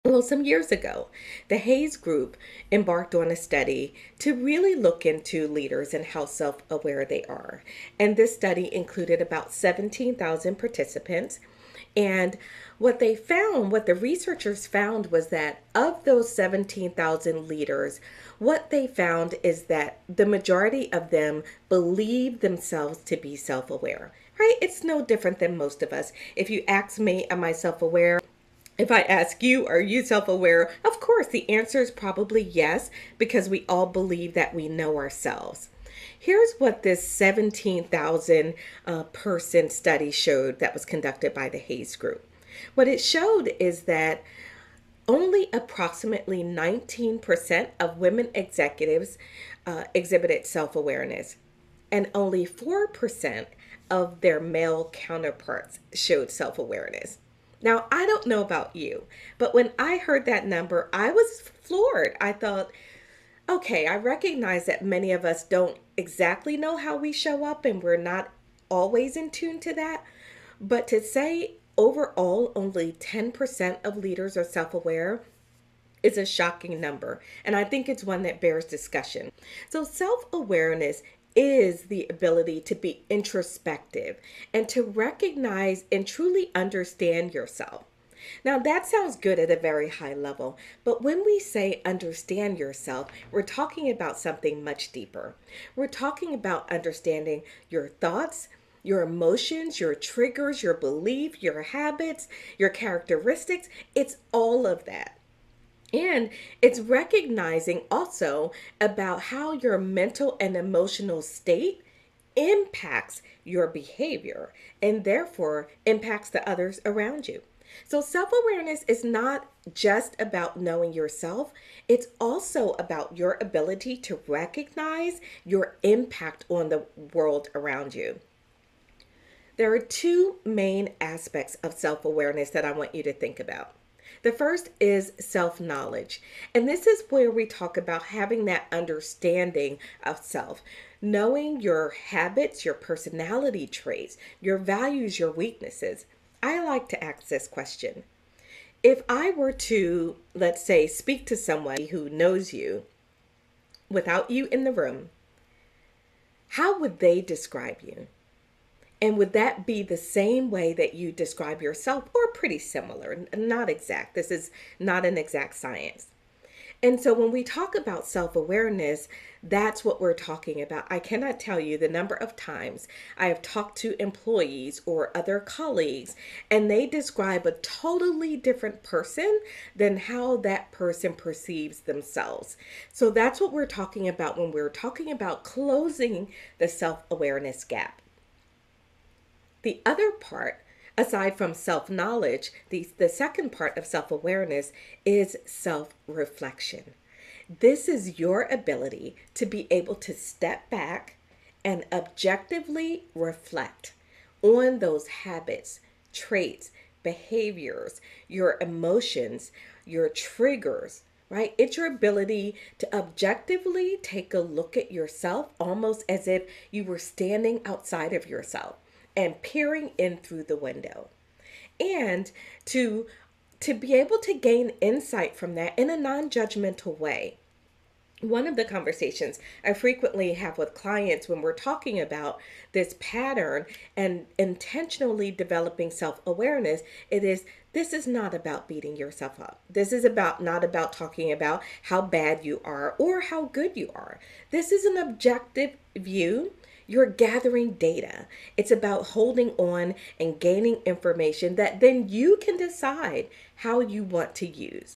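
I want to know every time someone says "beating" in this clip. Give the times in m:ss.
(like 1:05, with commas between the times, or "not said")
3:58.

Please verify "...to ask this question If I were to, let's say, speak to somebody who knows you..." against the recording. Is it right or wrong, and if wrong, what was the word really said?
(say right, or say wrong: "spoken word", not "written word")
right.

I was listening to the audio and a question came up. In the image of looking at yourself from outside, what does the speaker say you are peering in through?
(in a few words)
The window.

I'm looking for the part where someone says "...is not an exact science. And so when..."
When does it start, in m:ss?
2:44.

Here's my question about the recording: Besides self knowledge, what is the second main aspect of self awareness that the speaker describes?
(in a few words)
Self reflection.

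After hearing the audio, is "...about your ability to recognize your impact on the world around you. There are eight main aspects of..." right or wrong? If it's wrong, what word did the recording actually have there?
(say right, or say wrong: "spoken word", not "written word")
wrong: "two", not "eight".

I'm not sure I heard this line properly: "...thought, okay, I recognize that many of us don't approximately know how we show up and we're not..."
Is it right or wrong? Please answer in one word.
wrong.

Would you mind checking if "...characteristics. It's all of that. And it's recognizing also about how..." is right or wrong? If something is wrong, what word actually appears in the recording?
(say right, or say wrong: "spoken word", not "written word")
right.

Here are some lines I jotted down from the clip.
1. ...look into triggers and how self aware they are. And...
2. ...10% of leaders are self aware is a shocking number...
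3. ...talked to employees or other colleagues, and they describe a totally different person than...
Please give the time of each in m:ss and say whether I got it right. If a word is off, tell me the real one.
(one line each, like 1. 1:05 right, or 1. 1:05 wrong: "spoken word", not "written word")
1. 0:04 wrong: "leaders", not "triggers"
2. 1:12 right
3. 2:53 right.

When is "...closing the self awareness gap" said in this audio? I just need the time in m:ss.
3:05.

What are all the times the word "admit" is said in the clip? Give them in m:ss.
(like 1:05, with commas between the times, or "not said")
not said.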